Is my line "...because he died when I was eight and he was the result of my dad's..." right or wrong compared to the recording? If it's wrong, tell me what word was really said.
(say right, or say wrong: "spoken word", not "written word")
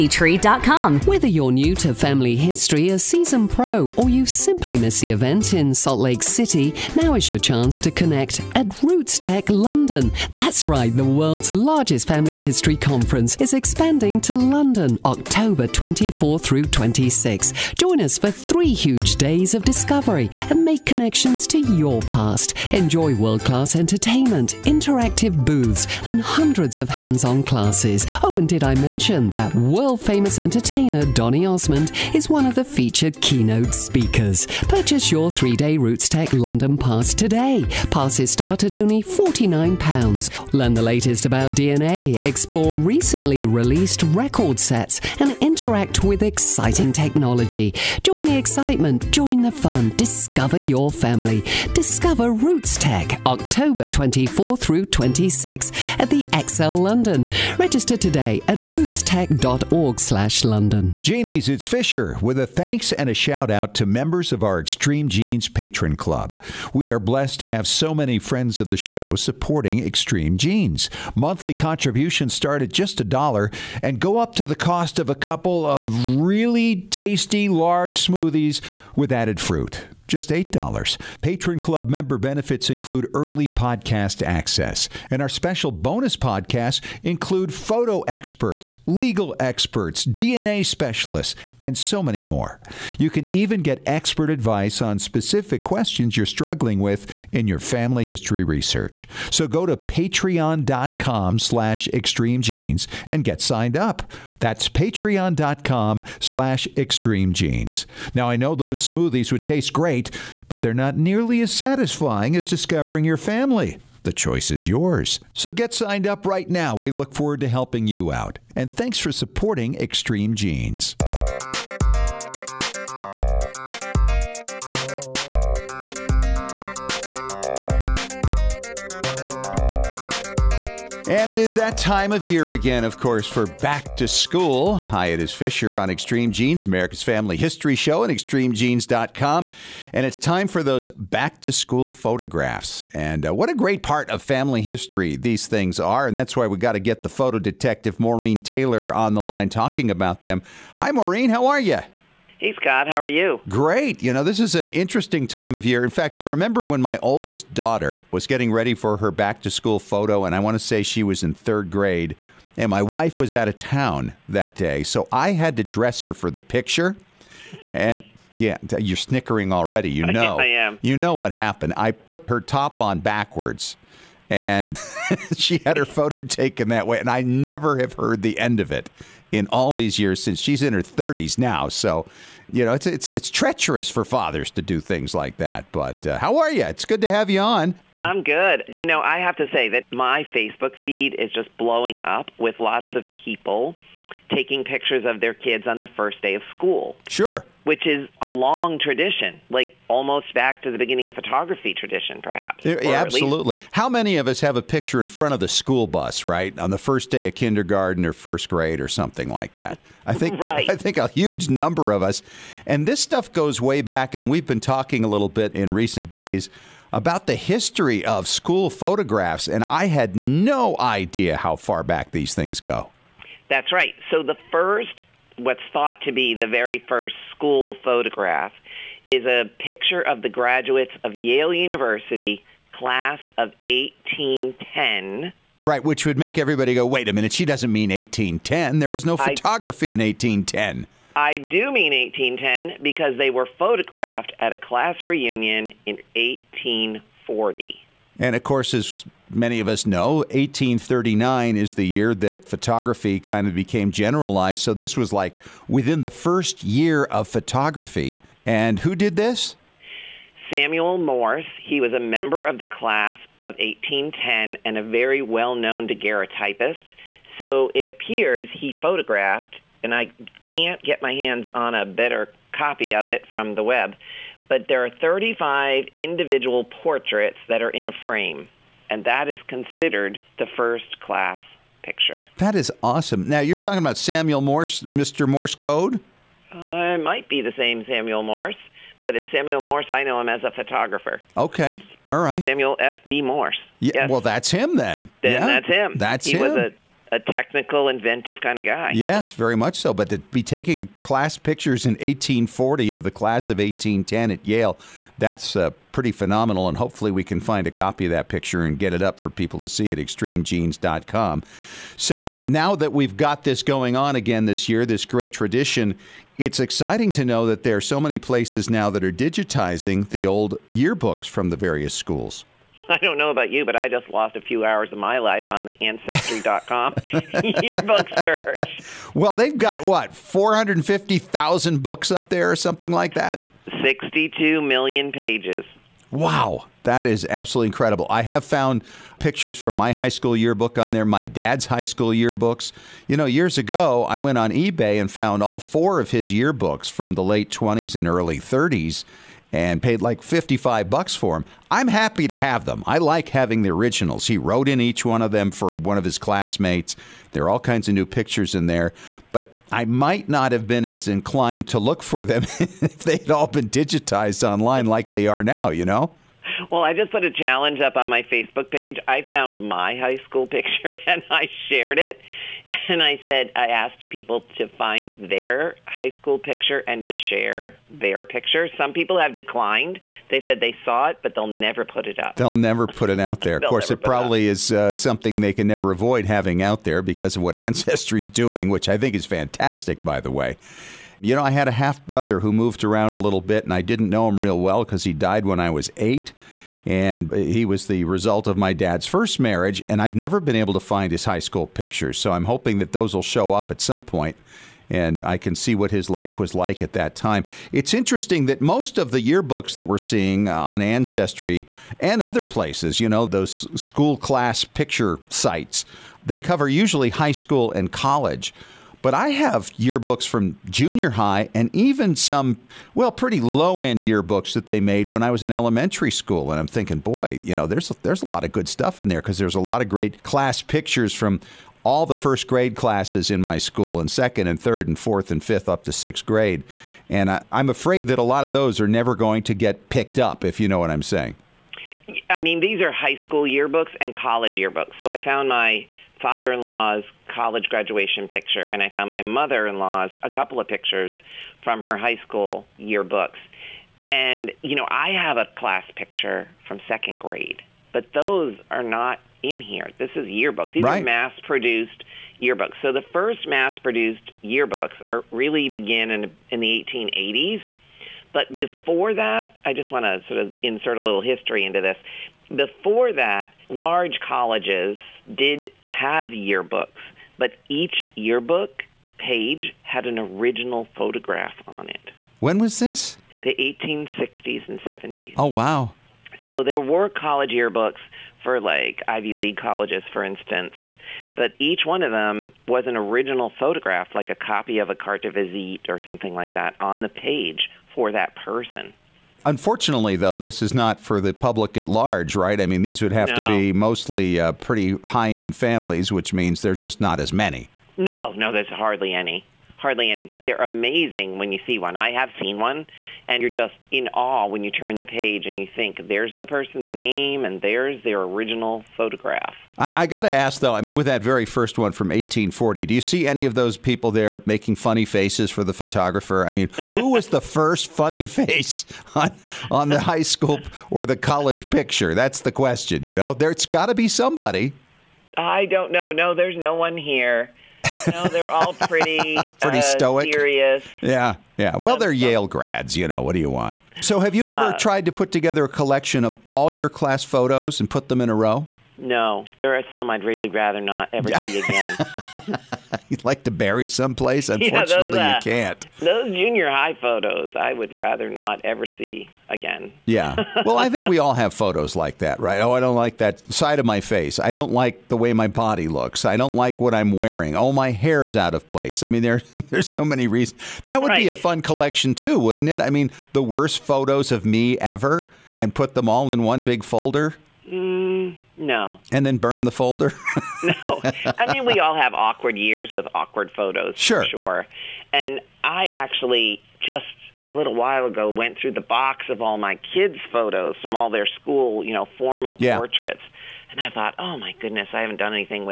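right.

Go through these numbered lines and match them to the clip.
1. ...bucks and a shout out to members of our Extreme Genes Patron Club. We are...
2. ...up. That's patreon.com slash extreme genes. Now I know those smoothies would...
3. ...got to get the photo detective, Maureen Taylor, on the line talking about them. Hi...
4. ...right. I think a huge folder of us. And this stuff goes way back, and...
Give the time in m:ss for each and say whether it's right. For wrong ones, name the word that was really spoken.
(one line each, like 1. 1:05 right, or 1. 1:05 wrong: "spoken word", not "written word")
1. 1:02 wrong: "thanks", not "bucks"
2. 1:43 right
3. 2:26 right
4. 3:30 wrong: "number", not "folder".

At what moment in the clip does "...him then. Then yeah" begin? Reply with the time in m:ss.
4:54.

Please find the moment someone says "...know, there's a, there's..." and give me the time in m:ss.
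7:07.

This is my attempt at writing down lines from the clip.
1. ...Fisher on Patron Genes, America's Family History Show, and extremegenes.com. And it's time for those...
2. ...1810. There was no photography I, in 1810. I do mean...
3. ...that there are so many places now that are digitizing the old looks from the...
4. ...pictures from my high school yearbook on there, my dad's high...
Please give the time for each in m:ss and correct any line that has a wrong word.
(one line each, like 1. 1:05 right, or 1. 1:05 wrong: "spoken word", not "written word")
1. 2:15 wrong: "Extreme", not "Patron"
2. 3:57 right
3. 5:17 wrong: "yearbooks", not "looks"
4. 5:39 right.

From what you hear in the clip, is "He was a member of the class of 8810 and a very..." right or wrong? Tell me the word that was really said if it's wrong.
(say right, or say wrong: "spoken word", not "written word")
wrong: "1810", not "8810".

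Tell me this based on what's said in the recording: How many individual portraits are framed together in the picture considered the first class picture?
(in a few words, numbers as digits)
35.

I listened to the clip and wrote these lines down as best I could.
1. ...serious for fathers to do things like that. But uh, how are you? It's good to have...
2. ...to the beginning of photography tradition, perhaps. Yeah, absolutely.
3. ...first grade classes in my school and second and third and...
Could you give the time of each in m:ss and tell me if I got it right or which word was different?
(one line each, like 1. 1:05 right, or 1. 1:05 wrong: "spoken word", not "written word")
1. 3:03 wrong: "treacherous", not "serious"
2. 3:20 right
3. 7:12 right.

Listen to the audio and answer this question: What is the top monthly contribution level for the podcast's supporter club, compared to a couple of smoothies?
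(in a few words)
$8.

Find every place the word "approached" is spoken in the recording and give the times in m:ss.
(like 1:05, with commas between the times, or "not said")
not said.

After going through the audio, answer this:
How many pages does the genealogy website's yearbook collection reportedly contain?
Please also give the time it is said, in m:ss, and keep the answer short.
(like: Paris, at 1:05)
62 million, at 5:33.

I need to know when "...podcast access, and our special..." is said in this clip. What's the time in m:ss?
1:23.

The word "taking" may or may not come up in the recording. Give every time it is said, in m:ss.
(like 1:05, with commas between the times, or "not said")
3:14, 5:00.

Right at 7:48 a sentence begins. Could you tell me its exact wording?
But before that, I just want to sort of insert a little history into this.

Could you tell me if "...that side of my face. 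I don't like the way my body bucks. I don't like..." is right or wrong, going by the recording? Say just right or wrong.
wrong.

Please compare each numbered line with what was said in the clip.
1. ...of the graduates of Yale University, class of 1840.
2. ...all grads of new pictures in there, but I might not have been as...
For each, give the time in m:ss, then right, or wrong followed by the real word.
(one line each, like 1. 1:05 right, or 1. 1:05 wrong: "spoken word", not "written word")
1. 3:50 wrong: "1810", not "1840"
2. 5:57 wrong: "kinds", not "grads".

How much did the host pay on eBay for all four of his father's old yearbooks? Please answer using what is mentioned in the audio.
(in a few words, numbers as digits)
$55.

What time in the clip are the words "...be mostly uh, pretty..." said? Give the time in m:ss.
8:23.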